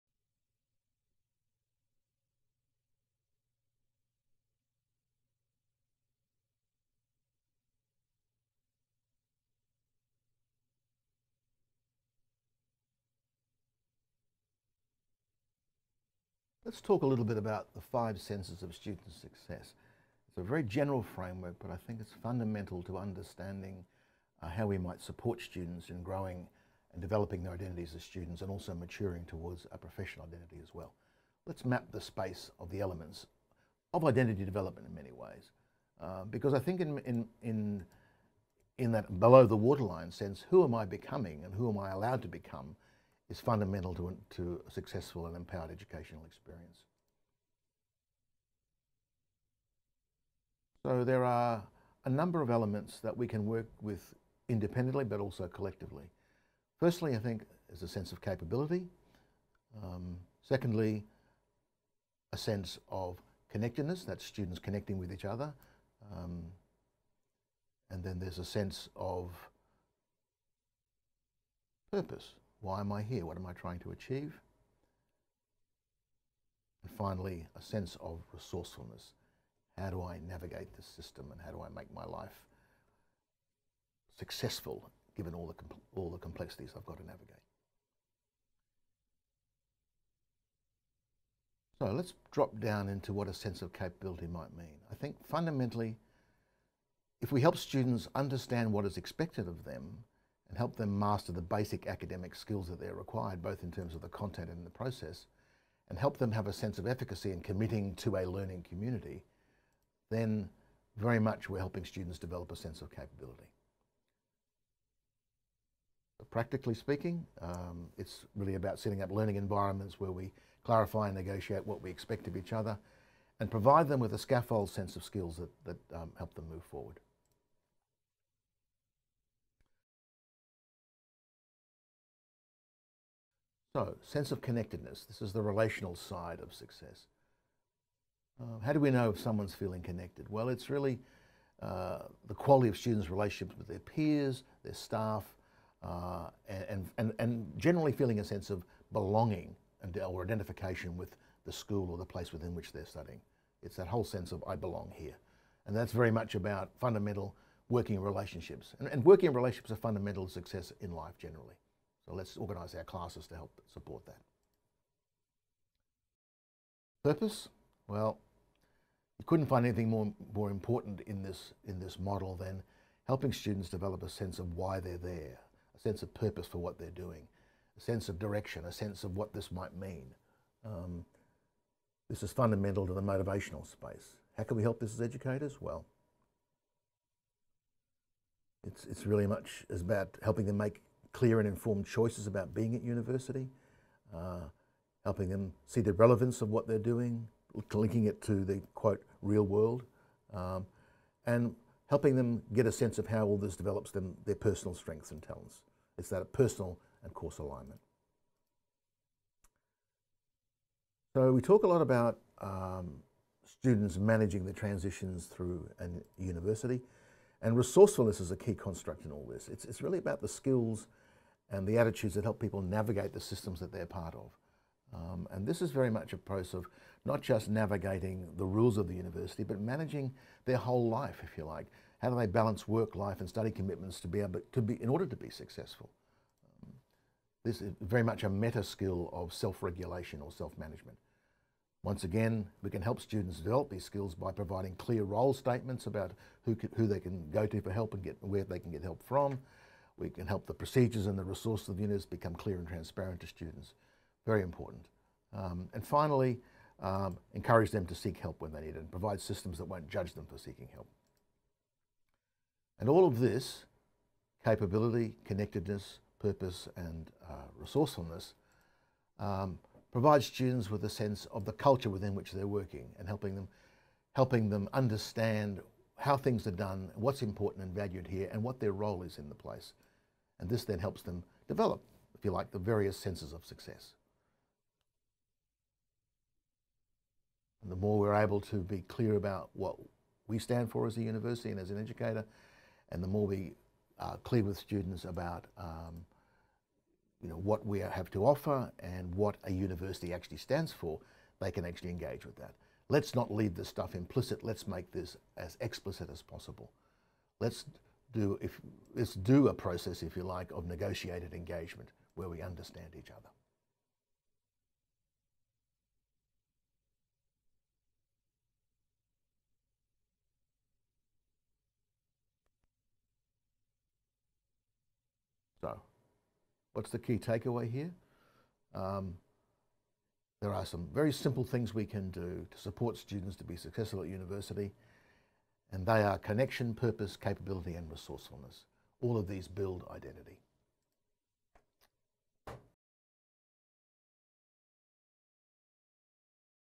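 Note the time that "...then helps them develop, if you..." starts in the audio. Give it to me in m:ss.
4:40.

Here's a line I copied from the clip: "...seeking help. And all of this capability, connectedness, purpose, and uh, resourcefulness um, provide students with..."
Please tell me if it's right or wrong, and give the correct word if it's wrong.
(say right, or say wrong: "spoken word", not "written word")
right.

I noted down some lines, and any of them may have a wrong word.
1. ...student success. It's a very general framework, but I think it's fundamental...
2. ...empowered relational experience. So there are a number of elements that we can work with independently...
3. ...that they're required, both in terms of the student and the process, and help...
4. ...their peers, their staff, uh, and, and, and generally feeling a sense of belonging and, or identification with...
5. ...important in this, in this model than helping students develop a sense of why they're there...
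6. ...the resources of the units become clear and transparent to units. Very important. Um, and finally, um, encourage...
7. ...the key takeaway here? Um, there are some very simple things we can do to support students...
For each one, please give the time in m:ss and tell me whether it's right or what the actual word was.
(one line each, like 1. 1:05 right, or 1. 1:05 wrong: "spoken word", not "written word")
1. 0:18 right
2. 0:45 wrong: "educational", not "relational"
3. 1:42 wrong: "content", not "student"
4. 2:23 right
5. 2:50 right
6. 4:11 wrong: "students", not "units"
7. 5:26 right.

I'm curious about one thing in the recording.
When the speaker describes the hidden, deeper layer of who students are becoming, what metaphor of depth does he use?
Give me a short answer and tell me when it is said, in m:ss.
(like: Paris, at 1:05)
below the waterline, at 0:39.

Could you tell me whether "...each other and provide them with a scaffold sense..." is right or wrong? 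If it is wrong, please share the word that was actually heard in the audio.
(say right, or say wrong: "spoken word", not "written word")
right.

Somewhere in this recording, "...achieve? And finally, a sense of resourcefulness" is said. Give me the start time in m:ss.
1:13.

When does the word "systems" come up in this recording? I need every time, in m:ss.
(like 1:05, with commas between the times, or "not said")
1:20, 3:43, 4:19.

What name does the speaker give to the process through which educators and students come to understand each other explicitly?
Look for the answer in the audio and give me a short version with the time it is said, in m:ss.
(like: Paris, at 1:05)
negotiated engagement, at 5:10.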